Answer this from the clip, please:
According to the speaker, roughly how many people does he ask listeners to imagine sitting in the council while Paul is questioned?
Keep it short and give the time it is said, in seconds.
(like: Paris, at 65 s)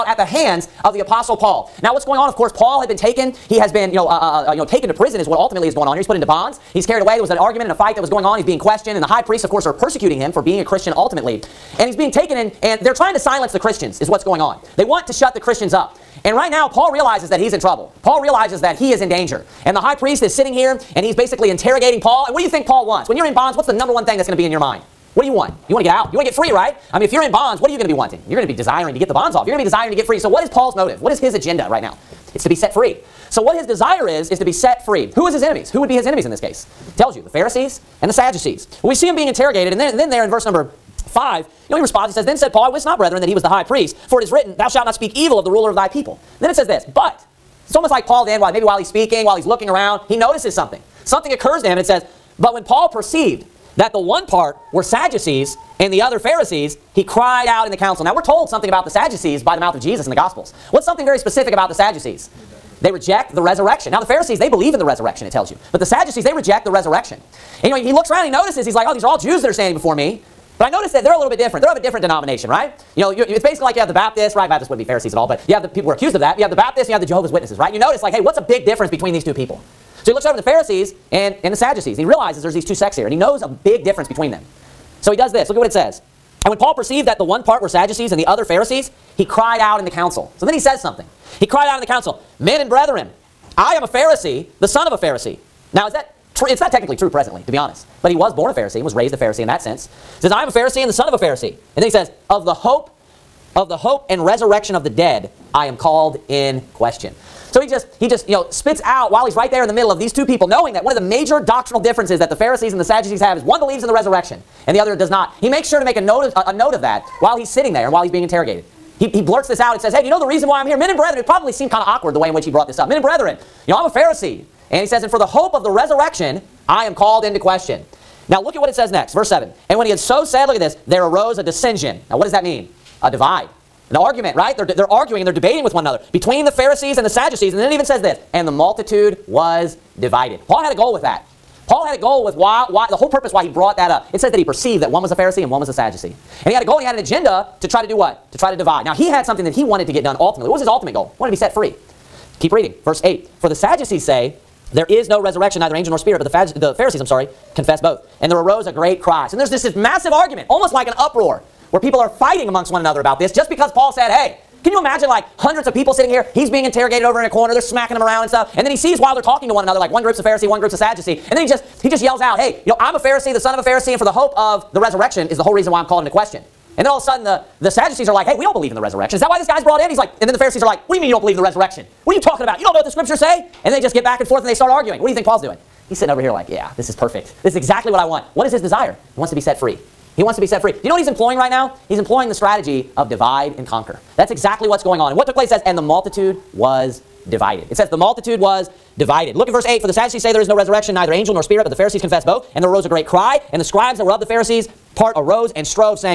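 hundreds, at 165 s.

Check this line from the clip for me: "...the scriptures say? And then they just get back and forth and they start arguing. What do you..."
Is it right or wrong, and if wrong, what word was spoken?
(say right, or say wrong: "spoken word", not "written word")
right.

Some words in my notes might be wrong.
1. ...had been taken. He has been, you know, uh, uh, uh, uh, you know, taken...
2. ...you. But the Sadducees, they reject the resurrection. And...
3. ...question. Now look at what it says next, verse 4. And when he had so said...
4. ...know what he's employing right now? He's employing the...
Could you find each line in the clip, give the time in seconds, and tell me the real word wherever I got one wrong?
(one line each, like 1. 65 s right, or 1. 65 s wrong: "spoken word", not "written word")
1. 2 s right
2. 65 s right
3. 127 s wrong: "7", not "4"
4. 190 s right.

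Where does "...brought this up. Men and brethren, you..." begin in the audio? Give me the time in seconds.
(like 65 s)
122 s.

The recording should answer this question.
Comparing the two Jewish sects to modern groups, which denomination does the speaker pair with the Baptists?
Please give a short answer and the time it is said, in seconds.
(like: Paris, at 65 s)
Jehovah's Witnesses, at 77 s.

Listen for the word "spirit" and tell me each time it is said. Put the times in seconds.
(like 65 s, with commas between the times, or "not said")
155 s, 201 s.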